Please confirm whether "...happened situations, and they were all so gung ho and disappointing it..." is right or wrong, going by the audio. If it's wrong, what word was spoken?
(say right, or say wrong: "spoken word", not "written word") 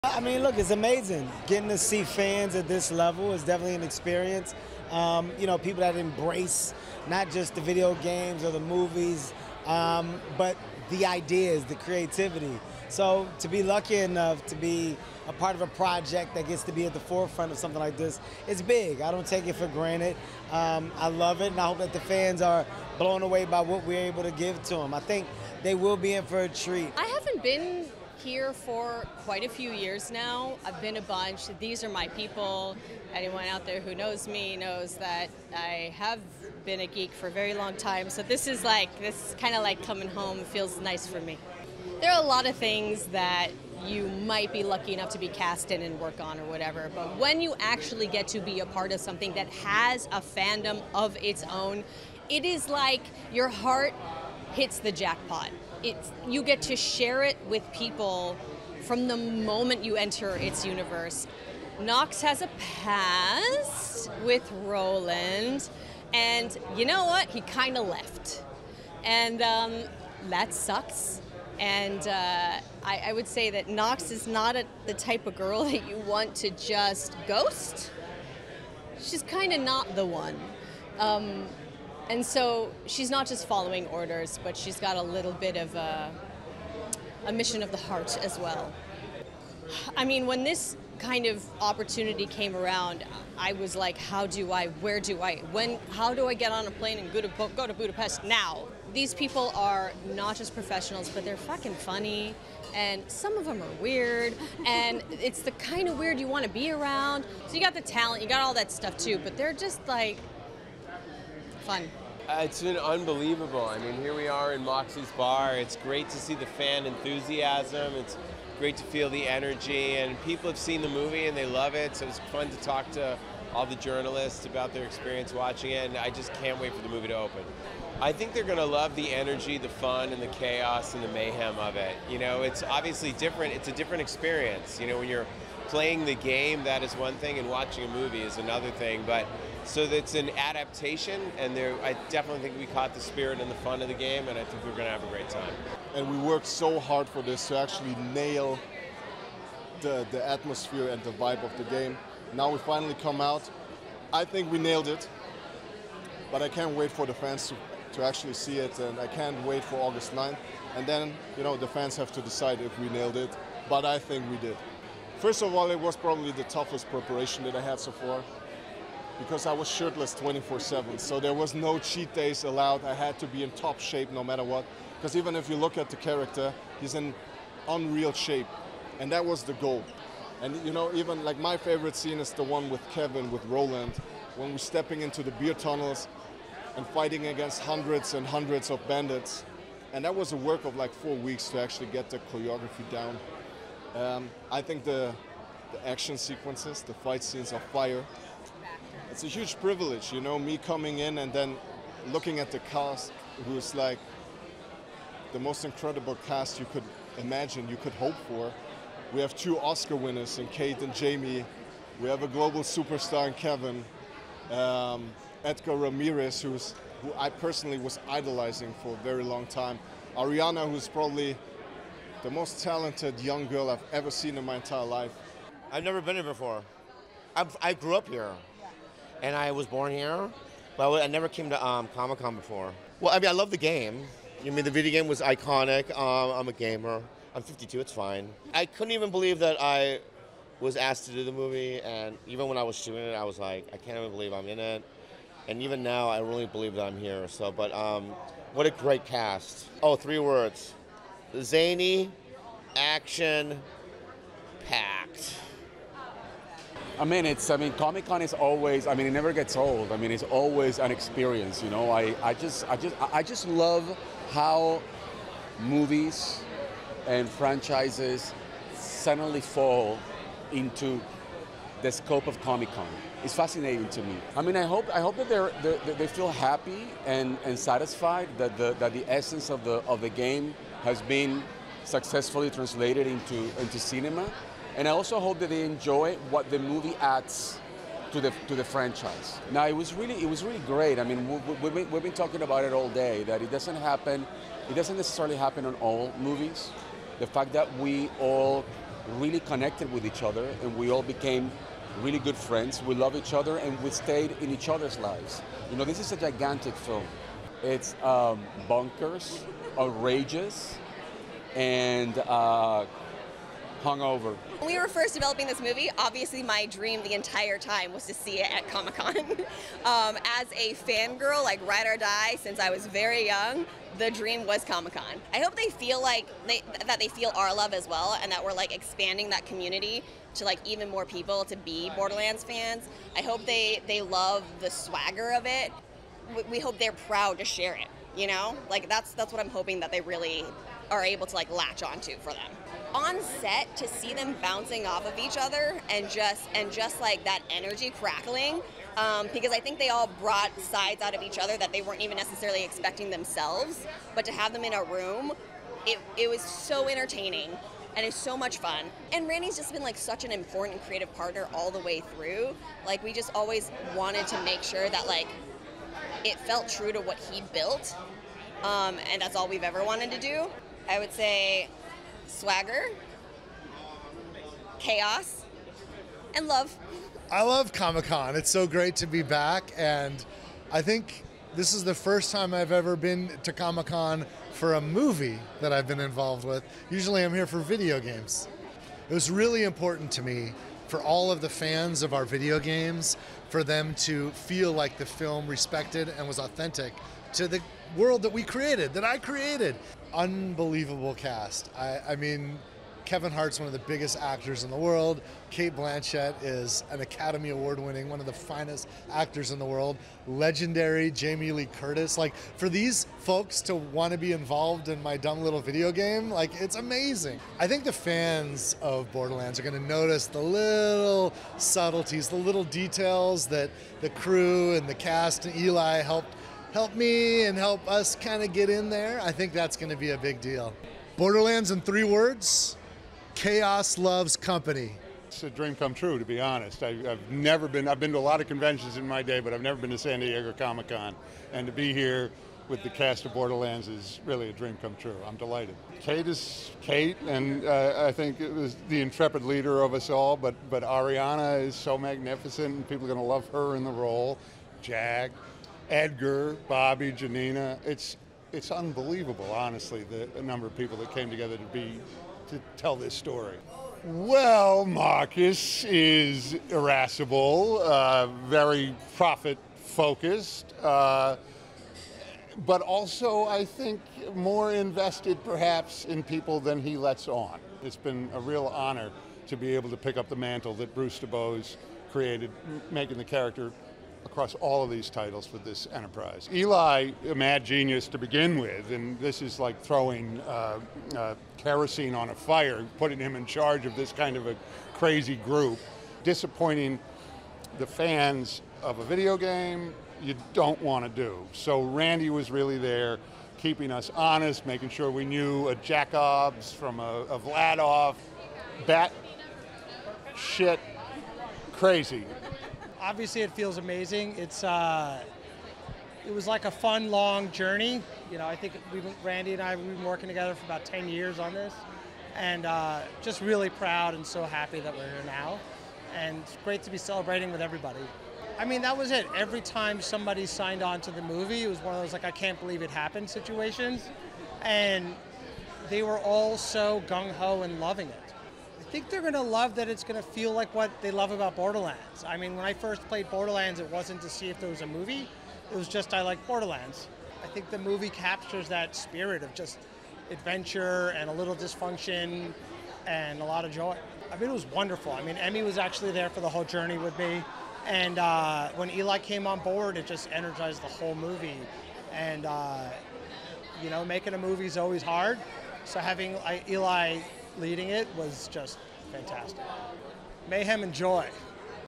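wrong: "loving", not "disappointing".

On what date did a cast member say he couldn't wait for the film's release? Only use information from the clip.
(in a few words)
August 9th.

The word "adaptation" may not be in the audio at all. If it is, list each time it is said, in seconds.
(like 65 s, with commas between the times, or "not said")
140 s.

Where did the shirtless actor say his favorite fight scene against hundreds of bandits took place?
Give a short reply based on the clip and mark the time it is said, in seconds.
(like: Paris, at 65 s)
The beer tunnels, at 185 s.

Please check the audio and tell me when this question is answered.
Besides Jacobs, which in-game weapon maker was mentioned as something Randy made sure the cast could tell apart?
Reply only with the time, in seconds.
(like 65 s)
507 s.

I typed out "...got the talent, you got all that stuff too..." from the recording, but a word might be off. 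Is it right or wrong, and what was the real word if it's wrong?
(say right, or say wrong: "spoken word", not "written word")
right.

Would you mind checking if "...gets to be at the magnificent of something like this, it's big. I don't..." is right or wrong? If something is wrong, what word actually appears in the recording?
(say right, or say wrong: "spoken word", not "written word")
wrong: "forefront", not "magnificent".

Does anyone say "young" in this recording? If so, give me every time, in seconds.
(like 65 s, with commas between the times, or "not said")
223 s, 323 s.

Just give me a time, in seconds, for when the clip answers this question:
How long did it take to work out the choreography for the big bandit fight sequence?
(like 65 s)
190 s.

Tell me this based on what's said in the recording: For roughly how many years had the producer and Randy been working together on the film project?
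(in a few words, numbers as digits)
About 10 years.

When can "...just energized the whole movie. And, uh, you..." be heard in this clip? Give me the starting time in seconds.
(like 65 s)
560 s.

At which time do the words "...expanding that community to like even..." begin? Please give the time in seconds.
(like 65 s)
328 s.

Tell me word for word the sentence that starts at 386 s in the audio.
Usually I'm here for video games.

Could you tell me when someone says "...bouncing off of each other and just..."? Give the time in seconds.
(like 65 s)
344 s.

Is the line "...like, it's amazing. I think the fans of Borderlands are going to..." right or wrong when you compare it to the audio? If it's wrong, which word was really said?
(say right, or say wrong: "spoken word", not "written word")
right.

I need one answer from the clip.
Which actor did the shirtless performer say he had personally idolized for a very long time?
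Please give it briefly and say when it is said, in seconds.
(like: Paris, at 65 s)
Edgar Ramirez, at 215 s.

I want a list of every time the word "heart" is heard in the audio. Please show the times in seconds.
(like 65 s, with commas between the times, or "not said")
53 s, 87 s.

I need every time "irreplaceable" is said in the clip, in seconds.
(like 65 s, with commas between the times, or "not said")
not said.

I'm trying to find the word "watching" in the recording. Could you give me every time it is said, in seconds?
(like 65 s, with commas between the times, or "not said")
125 s, 137 s.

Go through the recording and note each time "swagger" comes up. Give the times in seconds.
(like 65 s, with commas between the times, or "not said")
334 s, 372 s.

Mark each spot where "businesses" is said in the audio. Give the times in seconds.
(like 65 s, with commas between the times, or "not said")
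not said.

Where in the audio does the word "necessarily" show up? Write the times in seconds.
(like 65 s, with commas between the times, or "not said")
294 s, 352 s.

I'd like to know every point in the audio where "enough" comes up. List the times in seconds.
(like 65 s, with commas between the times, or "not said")
13 s, 44 s.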